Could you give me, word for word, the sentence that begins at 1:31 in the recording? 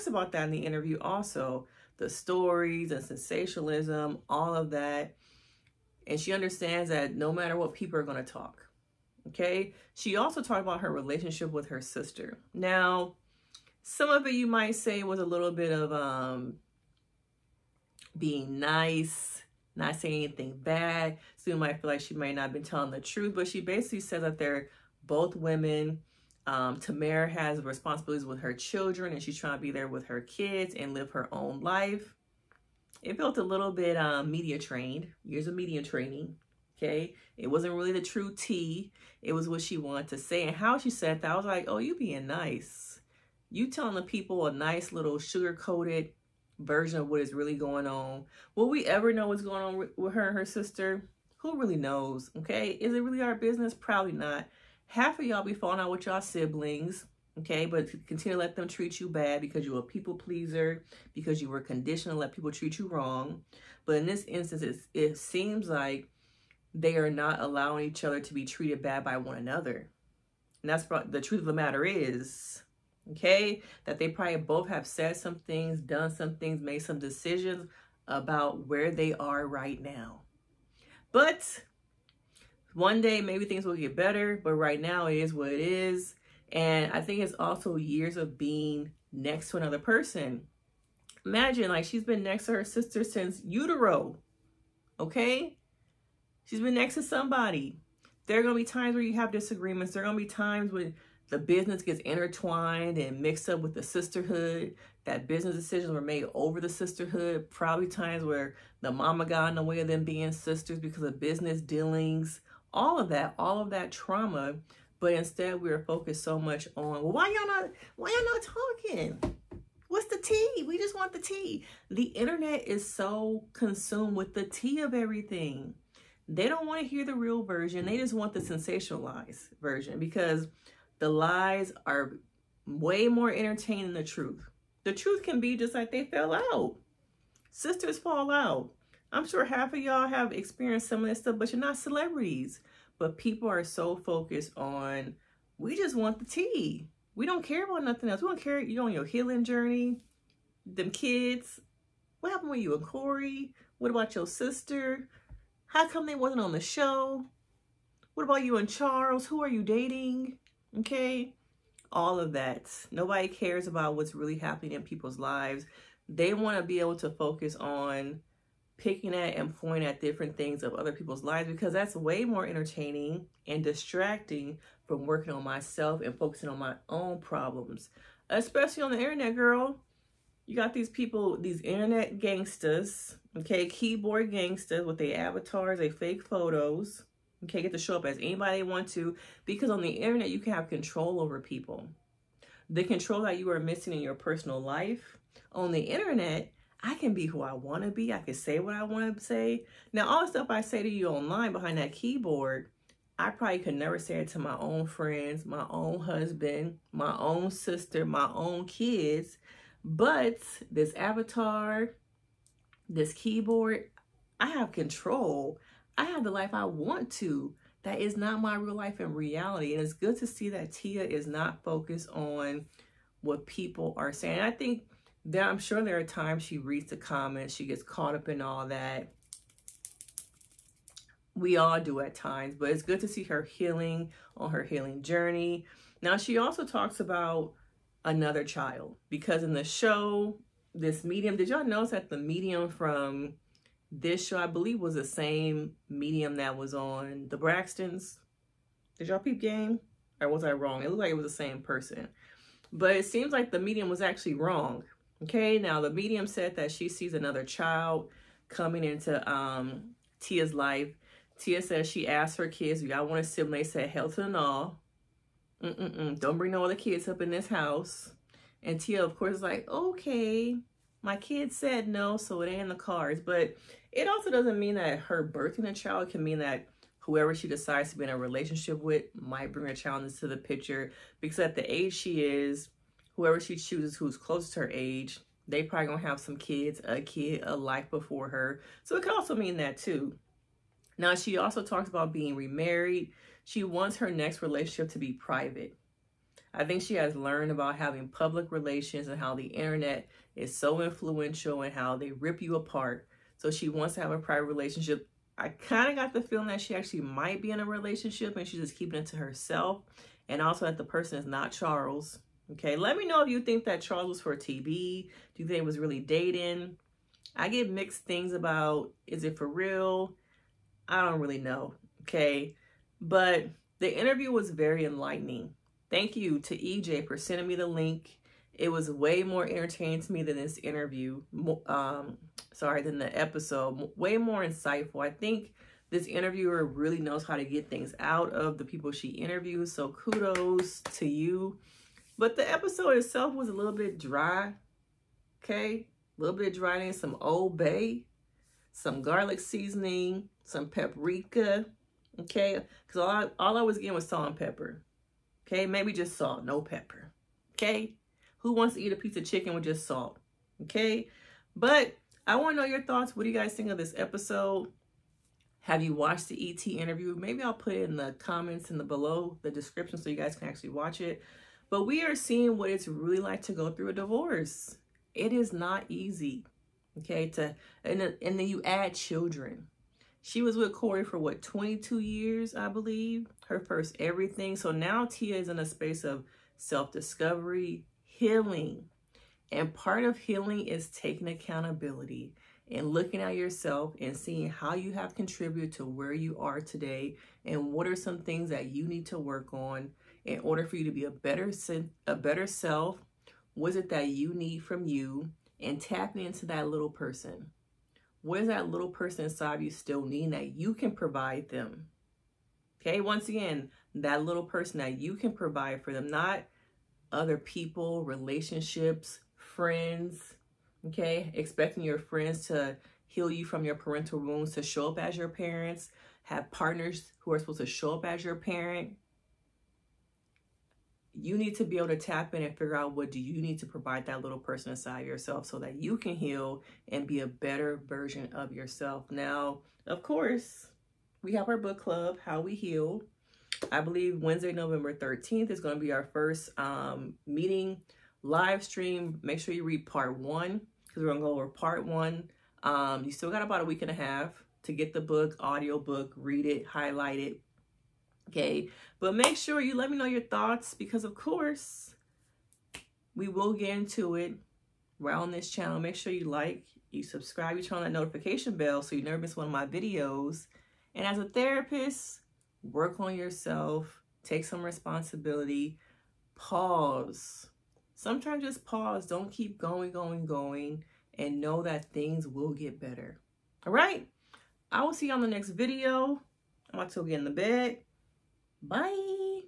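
Imagine like she's been next to her sister since utero, okay?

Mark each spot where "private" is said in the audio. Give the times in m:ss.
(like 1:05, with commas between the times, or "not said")
4:55, 5:04.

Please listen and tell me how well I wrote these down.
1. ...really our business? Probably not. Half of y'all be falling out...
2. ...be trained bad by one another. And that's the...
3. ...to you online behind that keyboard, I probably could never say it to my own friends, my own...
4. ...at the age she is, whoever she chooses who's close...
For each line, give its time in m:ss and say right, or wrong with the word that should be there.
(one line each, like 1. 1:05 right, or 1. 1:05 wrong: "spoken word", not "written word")
1. 0:53 right
2. 1:08 wrong: "treated", not "trained"
3. 3:20 right
4. 4:41 right.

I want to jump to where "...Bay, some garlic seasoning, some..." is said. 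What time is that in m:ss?
5:47.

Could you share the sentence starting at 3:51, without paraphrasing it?
We all do at times, but it's good to see her healing on her healing journey.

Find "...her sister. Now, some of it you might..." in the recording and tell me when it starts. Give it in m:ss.
0:11.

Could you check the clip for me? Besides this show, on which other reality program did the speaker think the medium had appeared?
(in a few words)
The Braxtons.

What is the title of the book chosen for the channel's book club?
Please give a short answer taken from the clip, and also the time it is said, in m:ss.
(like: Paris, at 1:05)
How We Heal, at 7:22.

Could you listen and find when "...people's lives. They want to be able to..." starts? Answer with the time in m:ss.
2:44.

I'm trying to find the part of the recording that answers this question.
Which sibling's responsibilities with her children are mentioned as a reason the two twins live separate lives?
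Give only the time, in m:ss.
0:26.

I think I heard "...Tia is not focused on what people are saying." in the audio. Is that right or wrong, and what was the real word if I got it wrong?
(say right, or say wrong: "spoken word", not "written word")
right.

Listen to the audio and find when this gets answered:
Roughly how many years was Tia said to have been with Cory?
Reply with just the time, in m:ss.
6:21.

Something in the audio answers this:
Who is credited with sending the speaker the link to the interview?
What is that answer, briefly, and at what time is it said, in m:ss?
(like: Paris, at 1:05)
EJ, at 5:26.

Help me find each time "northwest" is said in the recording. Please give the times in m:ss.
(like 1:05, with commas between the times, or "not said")
not said.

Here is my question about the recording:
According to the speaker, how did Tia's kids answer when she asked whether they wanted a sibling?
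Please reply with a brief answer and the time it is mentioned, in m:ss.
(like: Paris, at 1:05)
Hell to the no, at 4:23.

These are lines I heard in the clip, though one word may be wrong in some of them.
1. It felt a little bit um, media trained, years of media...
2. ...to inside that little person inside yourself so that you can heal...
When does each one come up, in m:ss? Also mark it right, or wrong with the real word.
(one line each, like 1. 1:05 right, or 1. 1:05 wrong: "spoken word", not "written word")
1. 0:33 right
2. 7:13 wrong: "provide", not "inside".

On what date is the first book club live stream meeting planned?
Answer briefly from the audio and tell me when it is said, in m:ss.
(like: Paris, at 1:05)
November 13th, at 7:24.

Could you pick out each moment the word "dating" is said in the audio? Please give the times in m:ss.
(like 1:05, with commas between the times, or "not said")
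2:39, 5:15.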